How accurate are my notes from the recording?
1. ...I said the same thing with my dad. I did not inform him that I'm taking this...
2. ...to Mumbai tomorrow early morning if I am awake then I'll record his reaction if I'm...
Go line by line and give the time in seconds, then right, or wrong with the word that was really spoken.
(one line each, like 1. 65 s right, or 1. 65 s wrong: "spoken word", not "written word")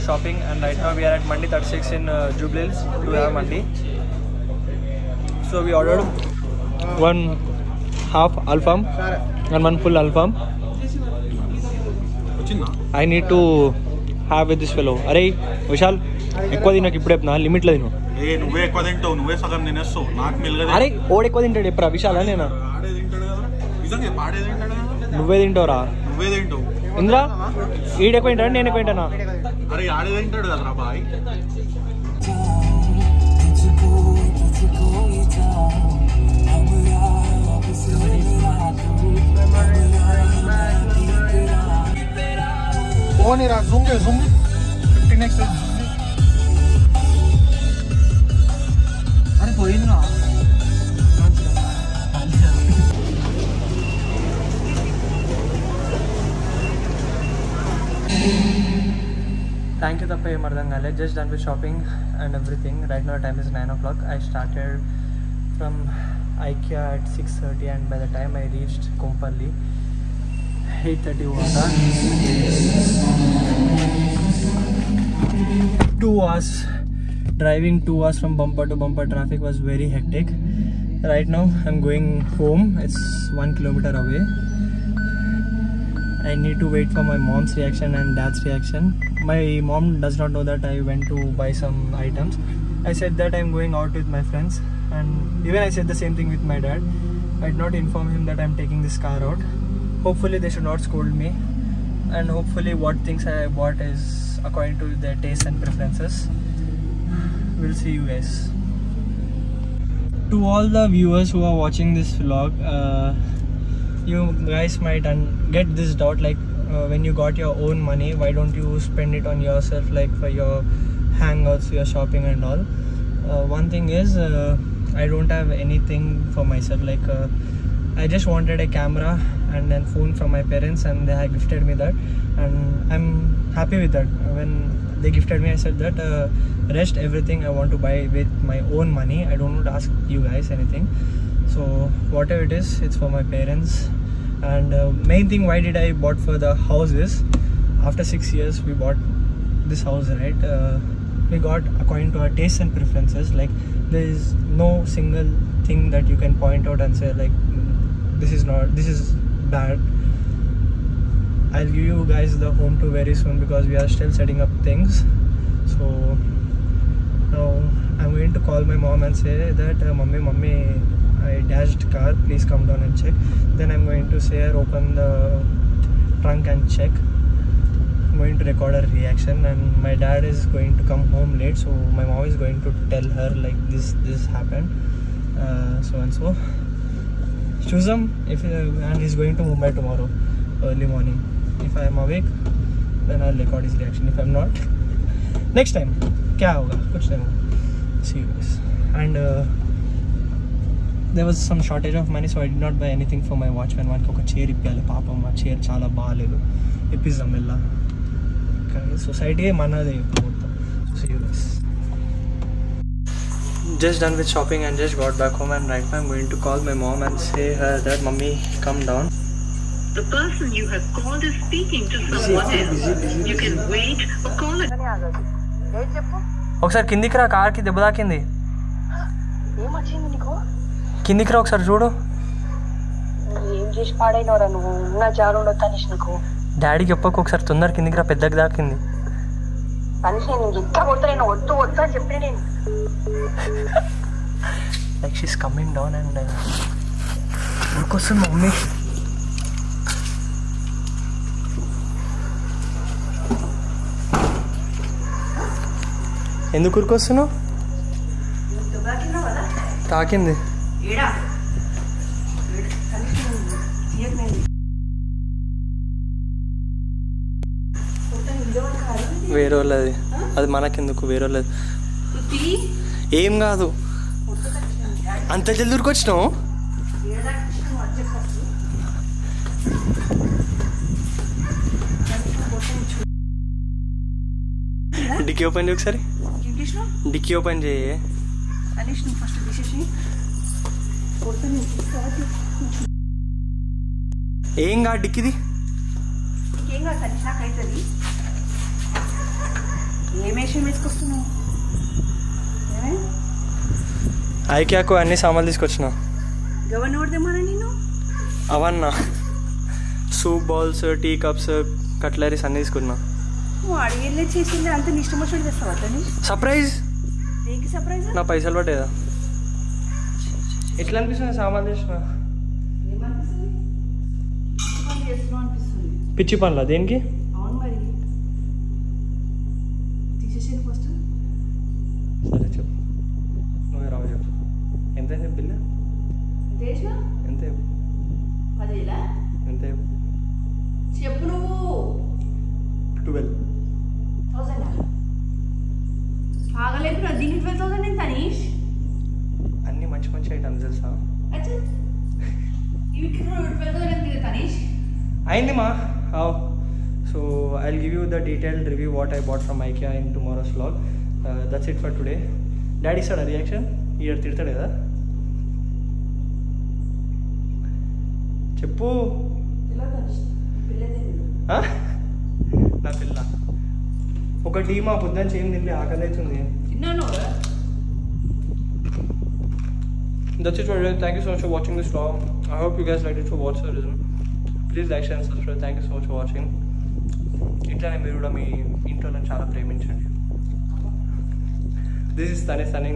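1. 95 s right
2. 189 s right.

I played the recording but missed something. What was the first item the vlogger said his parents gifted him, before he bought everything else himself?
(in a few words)
camera.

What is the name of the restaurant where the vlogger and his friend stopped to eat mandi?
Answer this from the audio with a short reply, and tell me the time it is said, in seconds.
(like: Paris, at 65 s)
Mandi 36, at 1 s.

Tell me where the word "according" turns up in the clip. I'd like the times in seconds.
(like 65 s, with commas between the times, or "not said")
104 s, 151 s.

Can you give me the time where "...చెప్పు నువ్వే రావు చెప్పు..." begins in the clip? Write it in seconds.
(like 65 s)
332 s.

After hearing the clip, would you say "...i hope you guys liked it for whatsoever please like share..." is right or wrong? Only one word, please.
right.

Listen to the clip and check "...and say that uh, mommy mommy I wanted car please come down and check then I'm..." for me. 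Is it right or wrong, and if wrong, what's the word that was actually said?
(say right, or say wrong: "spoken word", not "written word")
wrong: "dashed", not "wanted".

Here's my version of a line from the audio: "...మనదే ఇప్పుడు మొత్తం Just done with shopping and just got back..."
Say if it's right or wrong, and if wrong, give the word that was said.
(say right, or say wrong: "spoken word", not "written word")
right.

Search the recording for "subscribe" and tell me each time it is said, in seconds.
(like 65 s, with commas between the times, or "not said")
385 s.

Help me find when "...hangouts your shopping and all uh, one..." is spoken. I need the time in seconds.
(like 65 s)
121 s.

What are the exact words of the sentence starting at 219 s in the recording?
The person you have called is speaking to someone busy, else.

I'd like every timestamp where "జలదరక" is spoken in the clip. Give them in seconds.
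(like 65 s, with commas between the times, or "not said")
275 s.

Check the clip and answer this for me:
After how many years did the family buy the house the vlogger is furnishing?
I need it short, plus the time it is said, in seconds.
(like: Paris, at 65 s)
6 years, at 148 s.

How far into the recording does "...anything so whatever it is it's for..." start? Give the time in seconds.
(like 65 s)
140 s.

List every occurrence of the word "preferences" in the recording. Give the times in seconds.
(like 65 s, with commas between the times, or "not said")
105 s, 152 s.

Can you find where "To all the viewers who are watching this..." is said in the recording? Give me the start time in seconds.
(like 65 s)
110 s.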